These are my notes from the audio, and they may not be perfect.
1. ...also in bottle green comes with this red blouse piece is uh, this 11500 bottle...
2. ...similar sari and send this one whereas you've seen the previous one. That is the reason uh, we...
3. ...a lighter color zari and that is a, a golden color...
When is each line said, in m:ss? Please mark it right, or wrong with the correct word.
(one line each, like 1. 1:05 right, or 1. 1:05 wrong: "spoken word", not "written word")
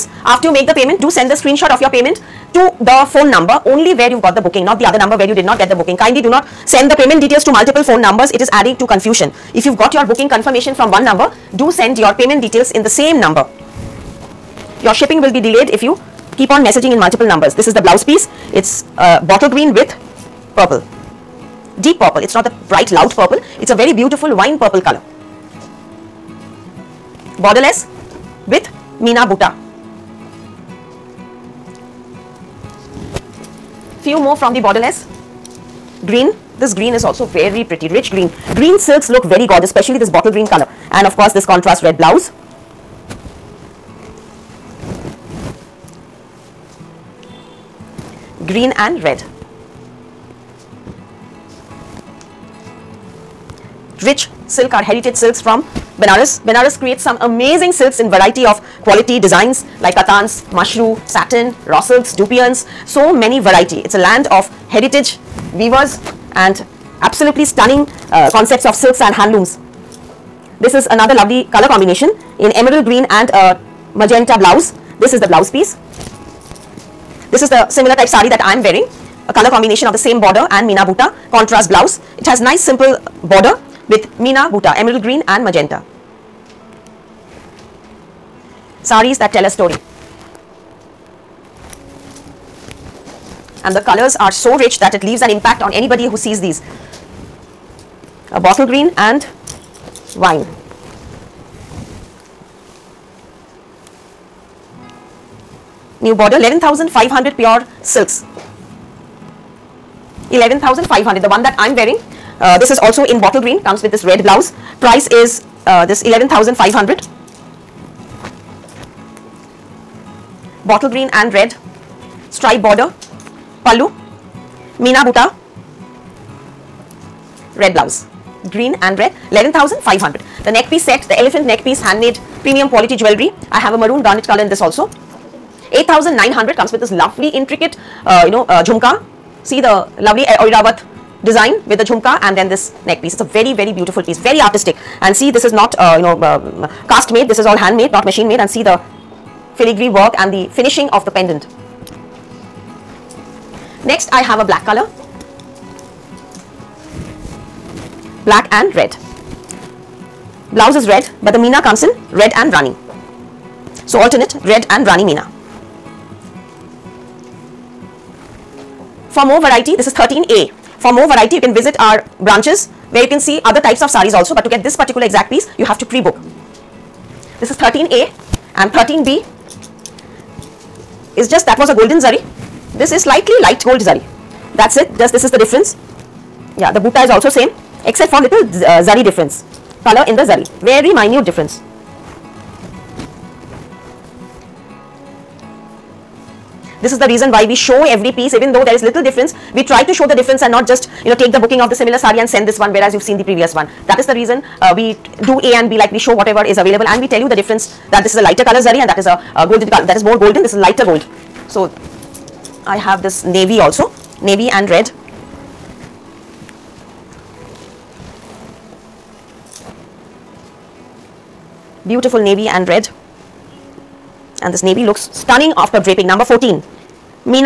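1. 1:52 wrong: "price", not "piece"
2. 3:21 right
3. 3:28 right.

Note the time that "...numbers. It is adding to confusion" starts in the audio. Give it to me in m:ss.
0:08.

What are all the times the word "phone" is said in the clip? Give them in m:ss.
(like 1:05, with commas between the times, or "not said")
0:03, 0:07.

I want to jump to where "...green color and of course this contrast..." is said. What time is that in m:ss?
0:40.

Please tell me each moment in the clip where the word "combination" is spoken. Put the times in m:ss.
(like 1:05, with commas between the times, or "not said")
1:11, 1:19.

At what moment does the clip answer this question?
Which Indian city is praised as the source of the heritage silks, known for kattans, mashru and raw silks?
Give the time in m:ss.
0:56.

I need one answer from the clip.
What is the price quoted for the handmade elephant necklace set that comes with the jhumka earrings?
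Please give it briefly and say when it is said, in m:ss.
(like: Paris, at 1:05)
8900, at 2:15.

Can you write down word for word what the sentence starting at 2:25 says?
And see, this is not, uh, you know, uh, cast made.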